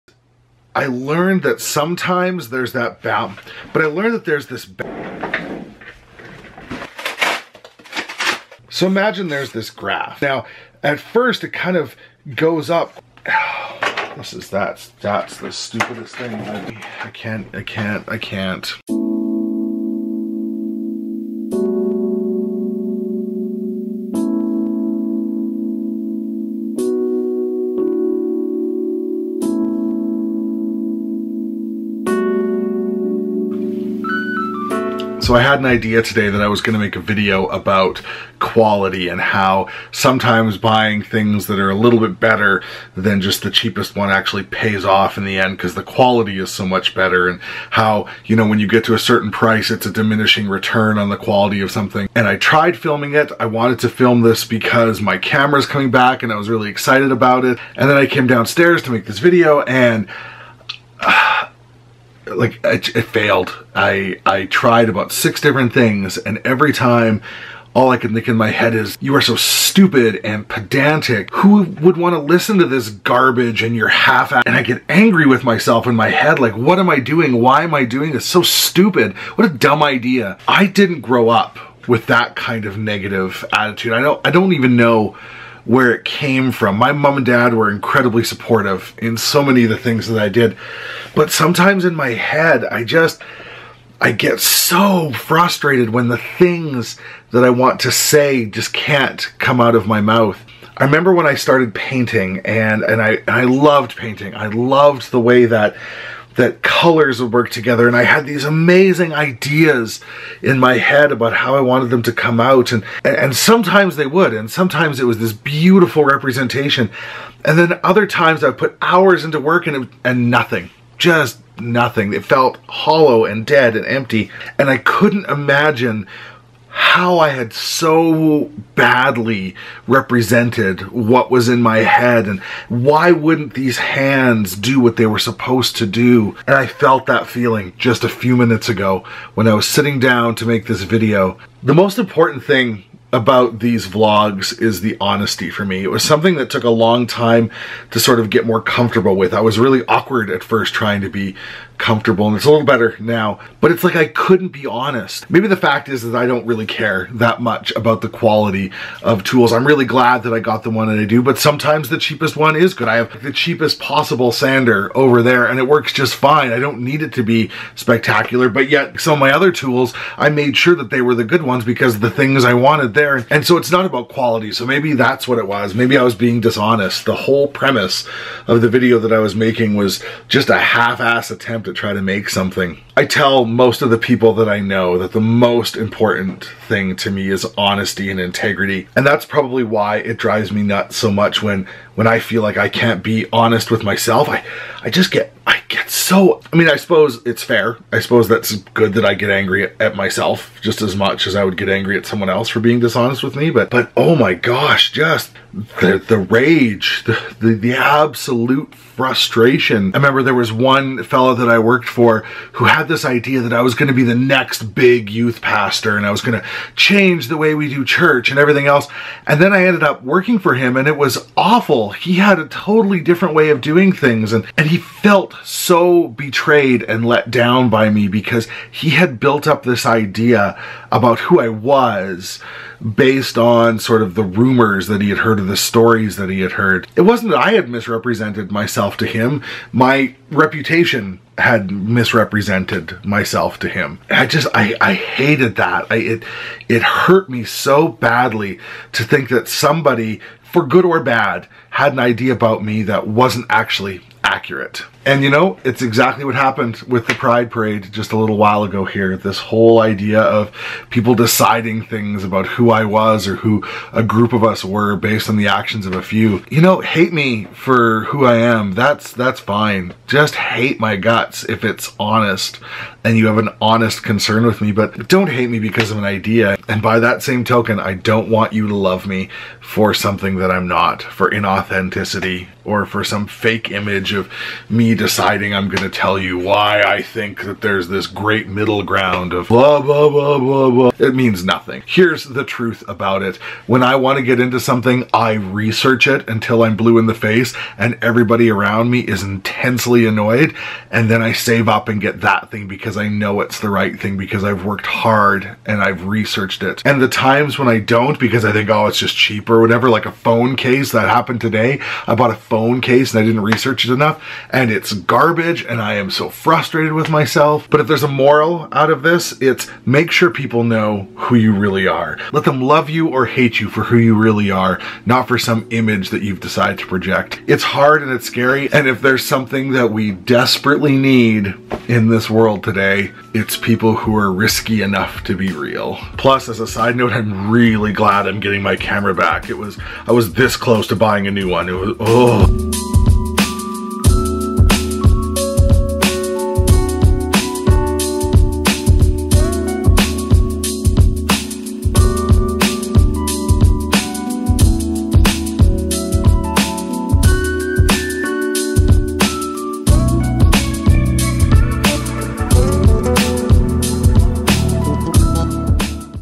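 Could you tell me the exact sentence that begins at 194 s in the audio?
I I just get I get so I mean, I suppose it's fair.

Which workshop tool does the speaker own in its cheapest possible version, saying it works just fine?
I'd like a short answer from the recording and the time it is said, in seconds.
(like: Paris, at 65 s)
Sander, at 164 s.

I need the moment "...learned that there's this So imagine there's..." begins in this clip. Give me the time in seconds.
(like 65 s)
3 s.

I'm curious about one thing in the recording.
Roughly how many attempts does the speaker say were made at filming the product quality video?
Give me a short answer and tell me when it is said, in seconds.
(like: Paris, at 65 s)
6, at 65 s.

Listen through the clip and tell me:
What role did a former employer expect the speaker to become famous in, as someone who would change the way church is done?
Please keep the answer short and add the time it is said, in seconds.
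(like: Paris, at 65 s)
Youth pastor, at 215 s.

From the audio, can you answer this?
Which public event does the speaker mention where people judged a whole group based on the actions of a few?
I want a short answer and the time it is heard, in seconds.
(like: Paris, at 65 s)
The Pride Parade, at 257 s.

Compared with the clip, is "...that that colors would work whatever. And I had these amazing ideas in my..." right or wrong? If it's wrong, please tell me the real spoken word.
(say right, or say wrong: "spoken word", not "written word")
wrong: "together", not "whatever".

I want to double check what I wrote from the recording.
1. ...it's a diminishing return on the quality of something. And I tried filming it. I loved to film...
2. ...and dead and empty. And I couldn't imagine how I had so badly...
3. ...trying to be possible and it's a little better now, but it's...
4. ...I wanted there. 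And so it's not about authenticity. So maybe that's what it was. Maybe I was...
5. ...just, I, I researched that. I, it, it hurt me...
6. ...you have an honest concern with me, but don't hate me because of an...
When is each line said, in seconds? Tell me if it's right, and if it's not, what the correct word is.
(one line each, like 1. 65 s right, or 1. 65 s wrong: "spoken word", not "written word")
1. 49 s wrong: "wanted", not "loved"
2. 123 s right
3. 150 s wrong: "comfortable", not "possible"
4. 172 s wrong: "quality", not "authenticity"
5. 244 s wrong: "hated", not "researched"
6. 273 s right.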